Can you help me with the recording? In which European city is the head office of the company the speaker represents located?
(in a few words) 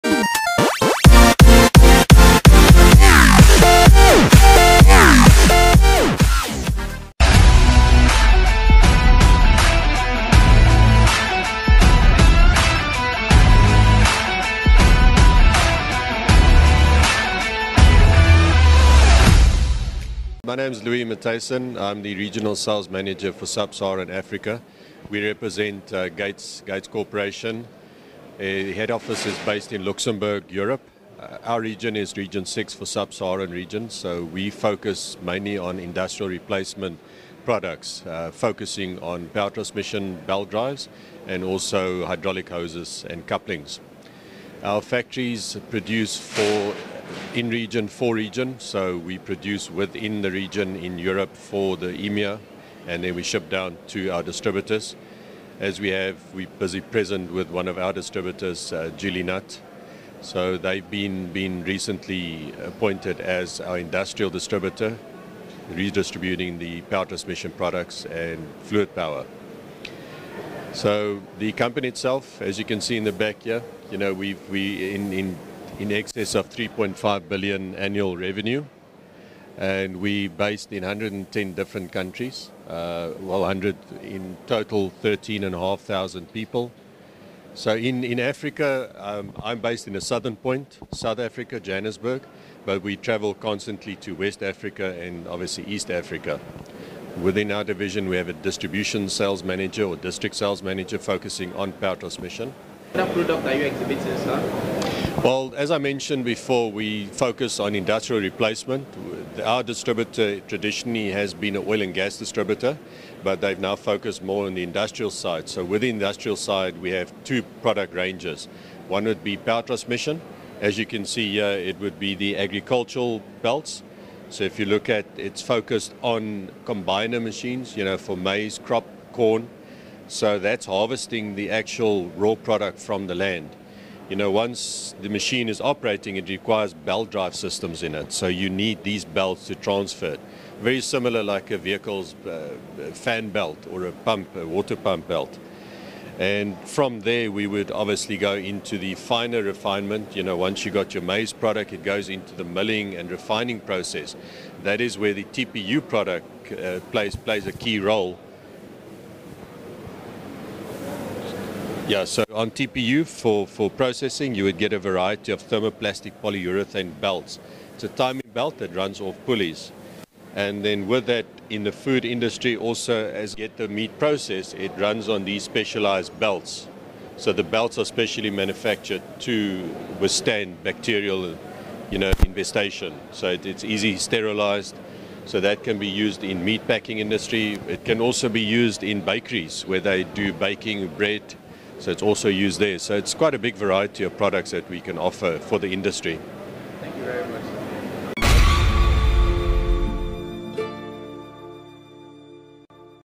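Luxembourg.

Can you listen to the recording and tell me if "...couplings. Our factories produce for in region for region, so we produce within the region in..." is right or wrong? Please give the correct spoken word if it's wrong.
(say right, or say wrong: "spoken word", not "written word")
right.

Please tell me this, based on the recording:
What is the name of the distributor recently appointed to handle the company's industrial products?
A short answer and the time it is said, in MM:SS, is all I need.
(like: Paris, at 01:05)
Gili Nut, at 00:58.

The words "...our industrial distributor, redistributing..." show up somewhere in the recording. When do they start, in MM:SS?
01:03.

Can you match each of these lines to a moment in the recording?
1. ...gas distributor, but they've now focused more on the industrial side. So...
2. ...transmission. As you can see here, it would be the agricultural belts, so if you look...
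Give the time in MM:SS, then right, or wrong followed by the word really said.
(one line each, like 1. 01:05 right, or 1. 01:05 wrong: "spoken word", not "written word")
1. 01:51 right
2. 01:59 right.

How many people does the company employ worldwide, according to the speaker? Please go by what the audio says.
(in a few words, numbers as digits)
13,500.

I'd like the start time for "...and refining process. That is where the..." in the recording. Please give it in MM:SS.
02:32.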